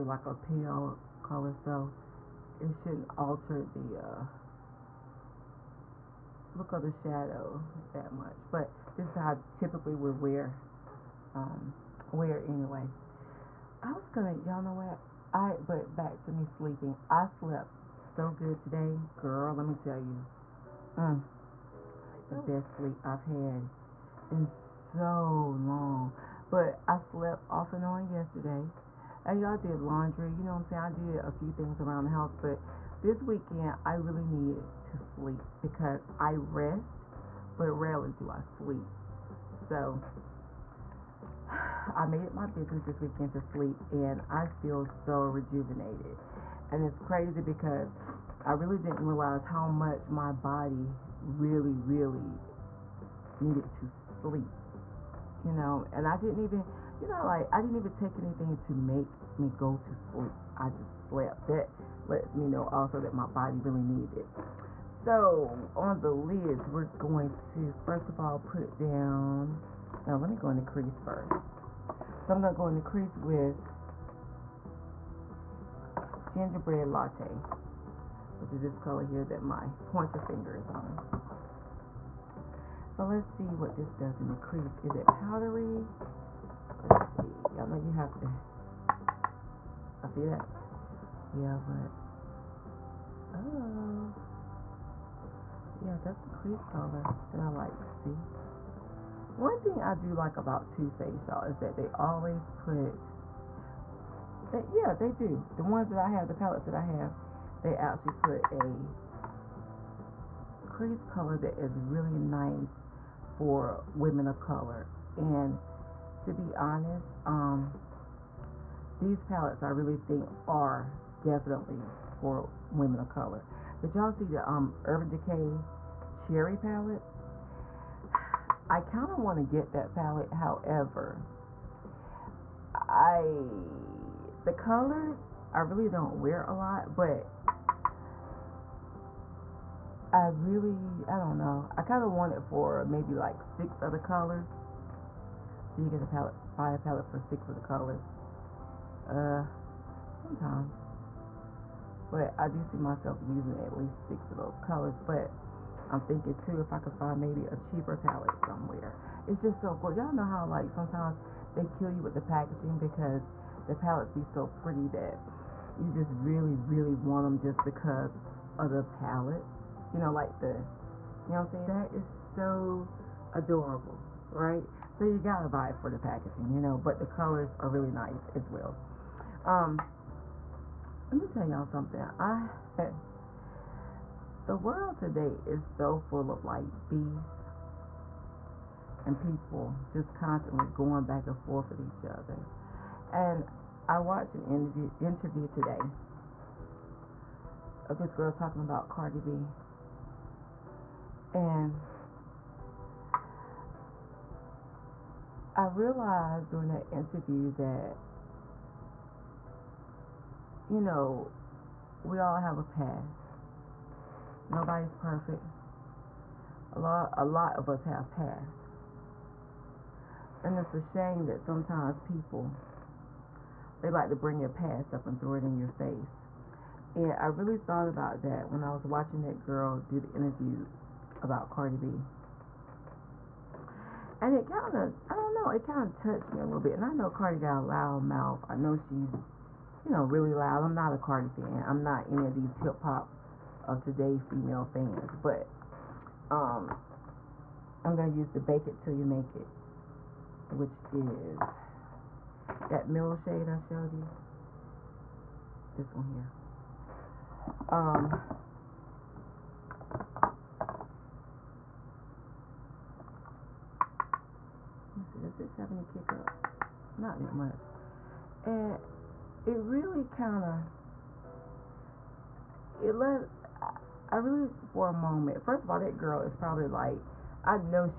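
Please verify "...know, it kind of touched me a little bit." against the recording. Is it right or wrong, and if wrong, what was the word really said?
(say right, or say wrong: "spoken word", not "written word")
right.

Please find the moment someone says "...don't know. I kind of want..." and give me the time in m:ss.
2:21.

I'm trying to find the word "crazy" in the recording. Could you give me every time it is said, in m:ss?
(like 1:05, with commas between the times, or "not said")
0:46.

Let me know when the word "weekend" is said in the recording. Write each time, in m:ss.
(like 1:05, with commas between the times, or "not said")
0:33, 0:42.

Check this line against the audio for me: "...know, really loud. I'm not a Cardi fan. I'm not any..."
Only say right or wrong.
right.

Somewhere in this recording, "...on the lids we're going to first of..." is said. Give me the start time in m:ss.
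1:05.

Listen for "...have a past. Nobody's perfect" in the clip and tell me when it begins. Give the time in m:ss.
3:32.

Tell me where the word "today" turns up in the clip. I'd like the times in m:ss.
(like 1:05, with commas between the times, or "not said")
0:18, 3:04, 3:15, 4:03.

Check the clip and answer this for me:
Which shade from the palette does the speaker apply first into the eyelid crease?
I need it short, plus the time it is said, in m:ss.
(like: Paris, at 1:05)
Gingerbread Latte, at 1:16.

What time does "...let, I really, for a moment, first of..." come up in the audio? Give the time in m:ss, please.
4:32.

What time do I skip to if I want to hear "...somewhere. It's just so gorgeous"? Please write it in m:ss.
2:38.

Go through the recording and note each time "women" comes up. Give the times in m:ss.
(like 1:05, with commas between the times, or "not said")
1:53, 2:02.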